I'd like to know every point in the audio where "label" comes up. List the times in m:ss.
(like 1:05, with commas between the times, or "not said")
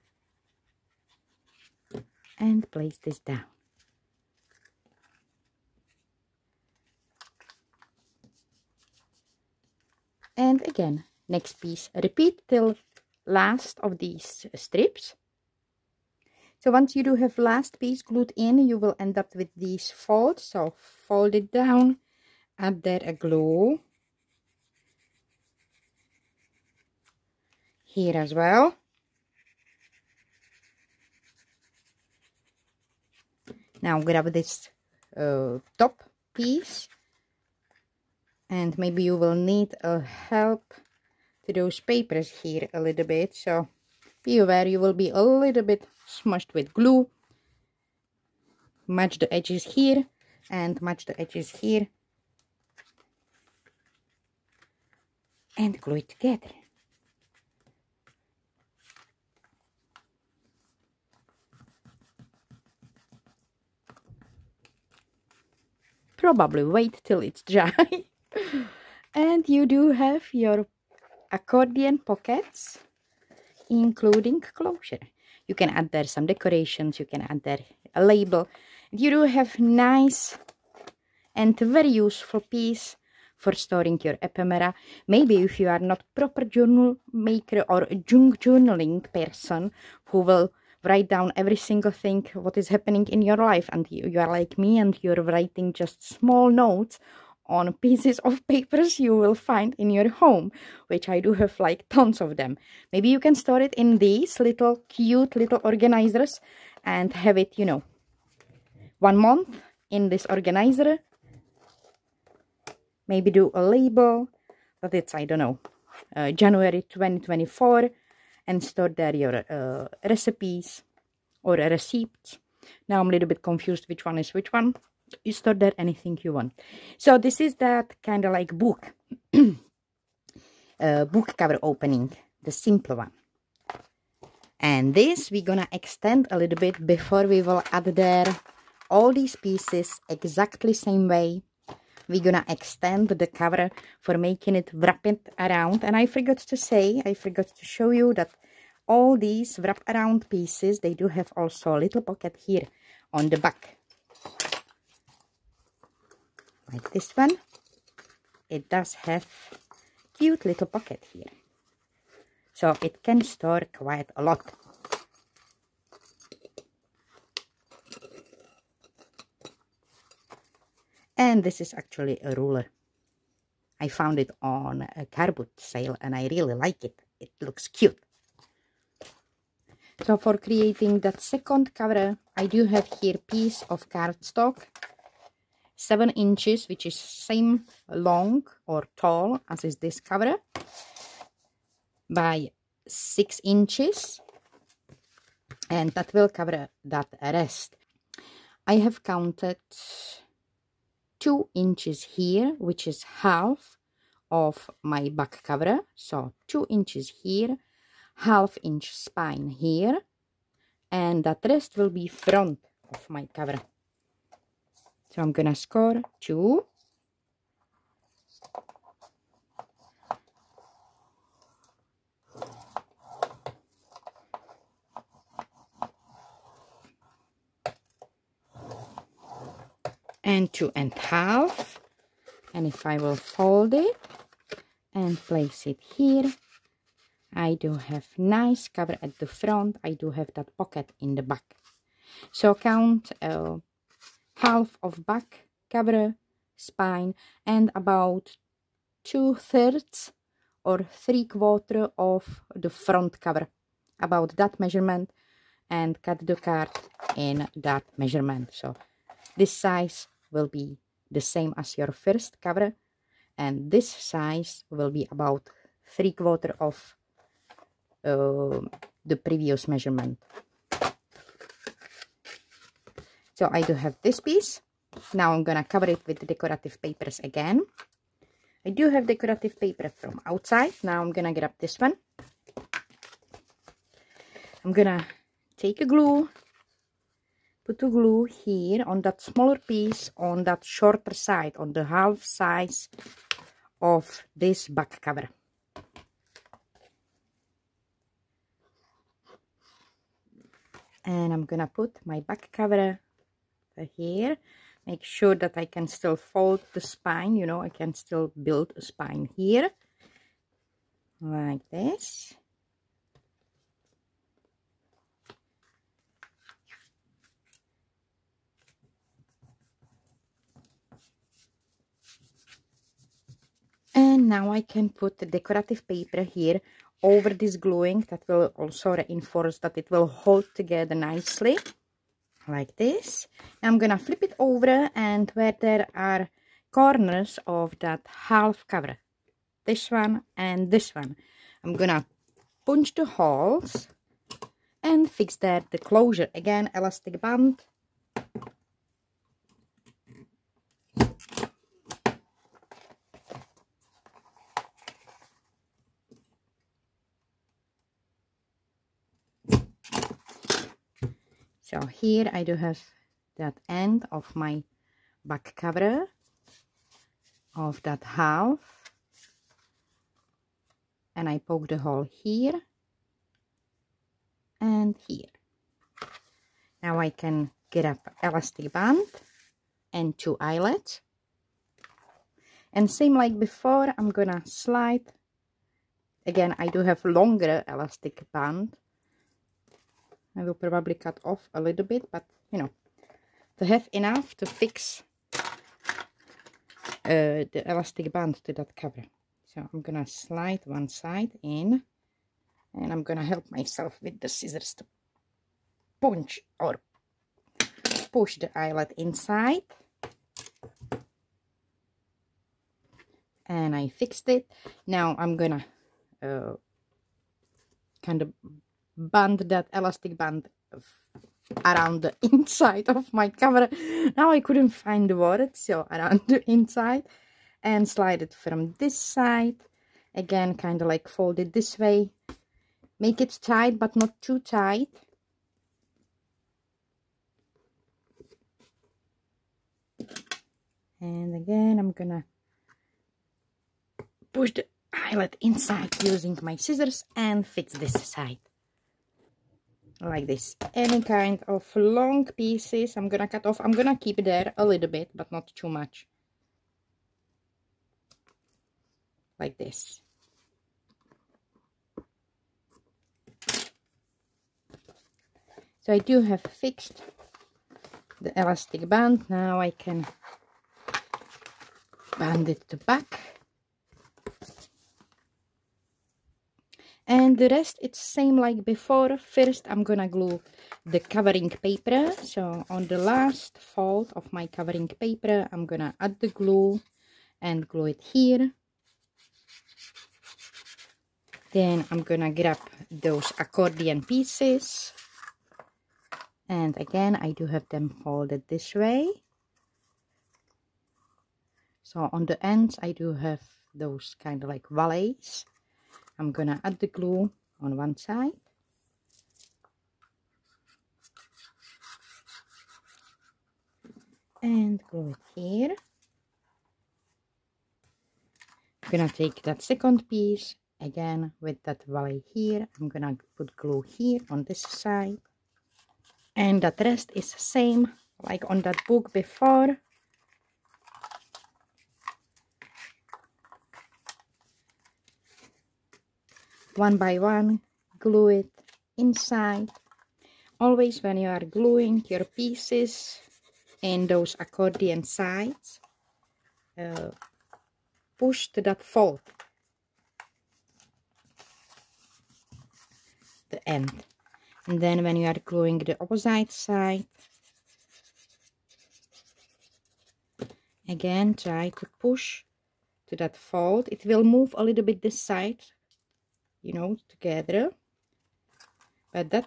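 1:18, 1:53.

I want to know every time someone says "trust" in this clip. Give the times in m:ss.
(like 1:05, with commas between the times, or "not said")
not said.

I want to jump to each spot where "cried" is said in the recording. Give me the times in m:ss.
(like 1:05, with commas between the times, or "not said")
not said.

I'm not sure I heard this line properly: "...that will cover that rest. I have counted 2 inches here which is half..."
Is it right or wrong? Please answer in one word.
right.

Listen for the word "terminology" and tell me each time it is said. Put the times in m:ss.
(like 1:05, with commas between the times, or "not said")
not said.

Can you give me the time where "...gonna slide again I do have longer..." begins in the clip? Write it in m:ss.
6:24.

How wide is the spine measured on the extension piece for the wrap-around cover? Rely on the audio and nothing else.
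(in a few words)
half inch.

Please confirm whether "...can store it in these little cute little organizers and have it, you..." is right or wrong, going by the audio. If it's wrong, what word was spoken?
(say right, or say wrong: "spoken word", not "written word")
right.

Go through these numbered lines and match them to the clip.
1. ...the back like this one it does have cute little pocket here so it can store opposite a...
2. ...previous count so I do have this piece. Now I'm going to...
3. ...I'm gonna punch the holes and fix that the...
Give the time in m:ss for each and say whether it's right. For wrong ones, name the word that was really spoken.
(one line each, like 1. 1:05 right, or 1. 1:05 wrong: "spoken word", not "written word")
1. 2:33 wrong: "quite", not "opposite"
2. 4:29 wrong: "measurement", not "count"
3. 5:41 right.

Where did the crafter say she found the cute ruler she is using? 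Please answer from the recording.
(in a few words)
a car boot sale.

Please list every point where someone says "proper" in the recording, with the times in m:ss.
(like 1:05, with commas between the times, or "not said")
1:26.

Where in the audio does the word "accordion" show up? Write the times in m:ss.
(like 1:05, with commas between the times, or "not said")
1:11, 8:13, 9:04.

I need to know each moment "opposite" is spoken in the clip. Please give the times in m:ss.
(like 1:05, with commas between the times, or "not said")
9:16.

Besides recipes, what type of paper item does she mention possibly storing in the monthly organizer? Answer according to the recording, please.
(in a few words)
receipts.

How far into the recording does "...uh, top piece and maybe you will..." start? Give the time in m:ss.
0:35.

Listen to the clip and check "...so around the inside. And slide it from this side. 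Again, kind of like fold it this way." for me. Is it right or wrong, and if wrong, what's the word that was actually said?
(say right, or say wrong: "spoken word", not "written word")
right.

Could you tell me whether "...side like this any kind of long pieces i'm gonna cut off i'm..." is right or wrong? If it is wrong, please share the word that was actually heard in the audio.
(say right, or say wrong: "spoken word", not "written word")
right.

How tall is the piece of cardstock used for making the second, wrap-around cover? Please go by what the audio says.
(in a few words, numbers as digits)
7 inches.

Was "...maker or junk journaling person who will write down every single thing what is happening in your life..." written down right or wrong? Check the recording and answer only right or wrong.
right.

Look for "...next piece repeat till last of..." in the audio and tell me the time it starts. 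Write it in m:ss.
0:11.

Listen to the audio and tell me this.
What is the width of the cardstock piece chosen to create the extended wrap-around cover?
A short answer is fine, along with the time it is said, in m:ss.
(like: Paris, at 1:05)
6 inches, at 3:12.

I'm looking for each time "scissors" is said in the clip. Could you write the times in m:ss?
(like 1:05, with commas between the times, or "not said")
6:44, 7:26.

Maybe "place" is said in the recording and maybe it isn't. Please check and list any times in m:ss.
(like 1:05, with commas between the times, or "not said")
0:02, 3:55.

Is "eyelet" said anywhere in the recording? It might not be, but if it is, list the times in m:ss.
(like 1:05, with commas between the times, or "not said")
6:20, 6:48, 7:24.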